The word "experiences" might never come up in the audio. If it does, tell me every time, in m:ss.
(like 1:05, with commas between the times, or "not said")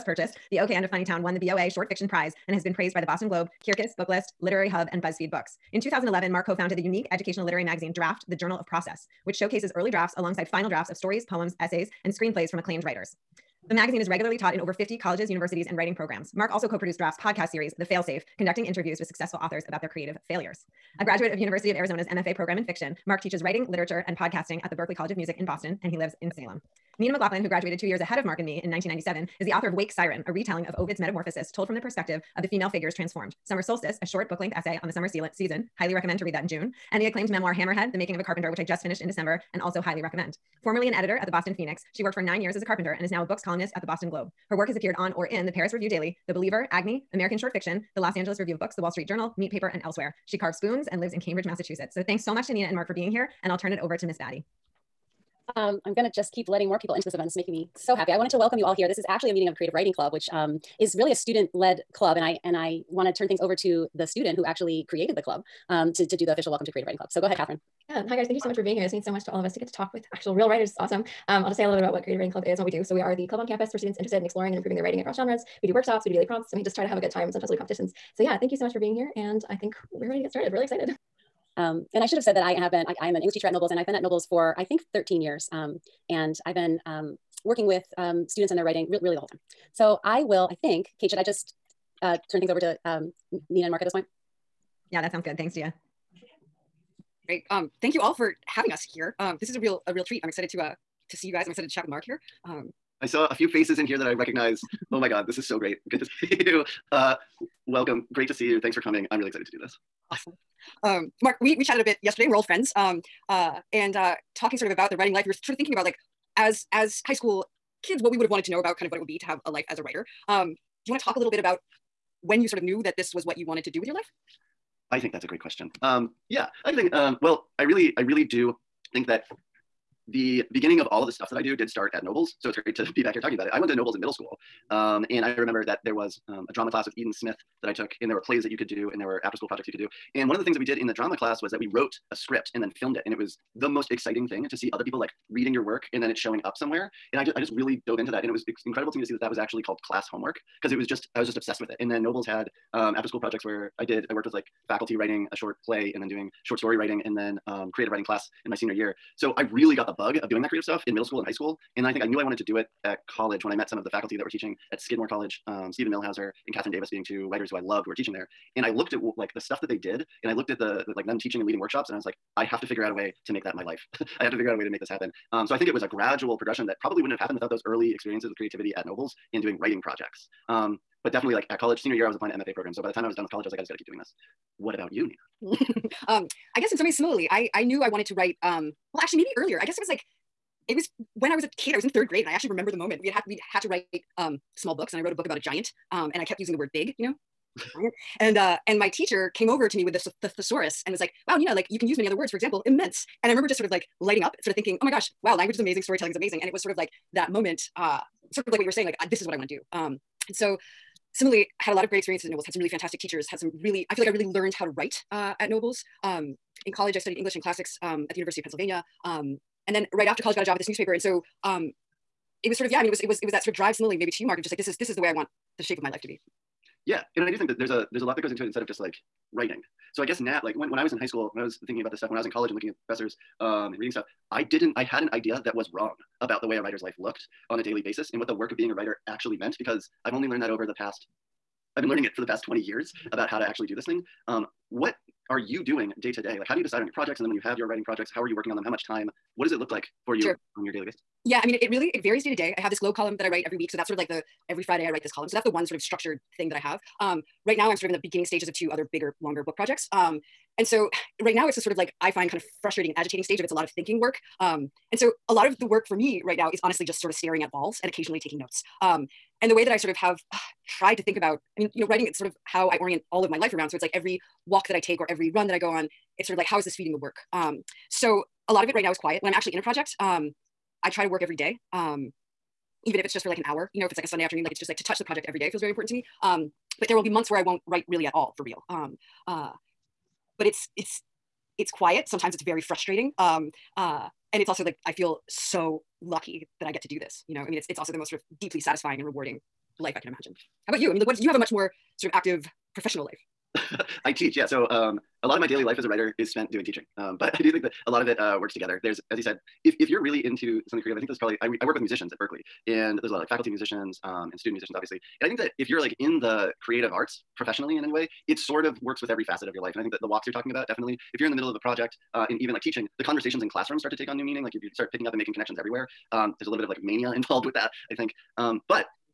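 2:57, 3:31.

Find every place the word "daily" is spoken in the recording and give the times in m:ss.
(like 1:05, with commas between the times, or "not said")
0:45, 1:16, 3:57, 4:10, 5:05.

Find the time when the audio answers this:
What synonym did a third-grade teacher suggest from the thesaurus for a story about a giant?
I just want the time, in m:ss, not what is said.
3:22.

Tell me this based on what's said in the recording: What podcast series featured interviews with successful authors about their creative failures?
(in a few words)
The Failsafe.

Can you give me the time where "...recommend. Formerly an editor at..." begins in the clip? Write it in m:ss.
0:40.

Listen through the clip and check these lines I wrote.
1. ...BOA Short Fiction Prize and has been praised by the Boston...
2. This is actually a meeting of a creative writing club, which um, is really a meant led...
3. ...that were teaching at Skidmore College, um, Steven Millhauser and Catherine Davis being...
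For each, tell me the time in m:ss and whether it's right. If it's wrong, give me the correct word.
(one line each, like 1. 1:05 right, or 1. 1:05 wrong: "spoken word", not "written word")
1. 0:01 right
2. 0:58 wrong: "student", not "meant"
3. 2:44 right.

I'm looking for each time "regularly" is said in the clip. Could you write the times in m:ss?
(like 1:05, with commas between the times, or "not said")
0:14.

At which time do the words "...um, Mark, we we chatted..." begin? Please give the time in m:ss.
1:50.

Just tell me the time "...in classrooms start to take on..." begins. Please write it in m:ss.
5:23.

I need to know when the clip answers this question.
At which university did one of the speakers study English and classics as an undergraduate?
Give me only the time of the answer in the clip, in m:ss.
3:38.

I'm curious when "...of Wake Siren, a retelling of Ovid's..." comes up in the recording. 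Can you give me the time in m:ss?
0:29.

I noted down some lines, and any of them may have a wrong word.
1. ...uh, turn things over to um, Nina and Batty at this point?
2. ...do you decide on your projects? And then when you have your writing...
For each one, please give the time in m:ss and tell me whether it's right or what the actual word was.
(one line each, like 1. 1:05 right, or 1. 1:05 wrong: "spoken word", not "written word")
1. 1:32 wrong: "Mark", not "Batty"
2. 4:06 right.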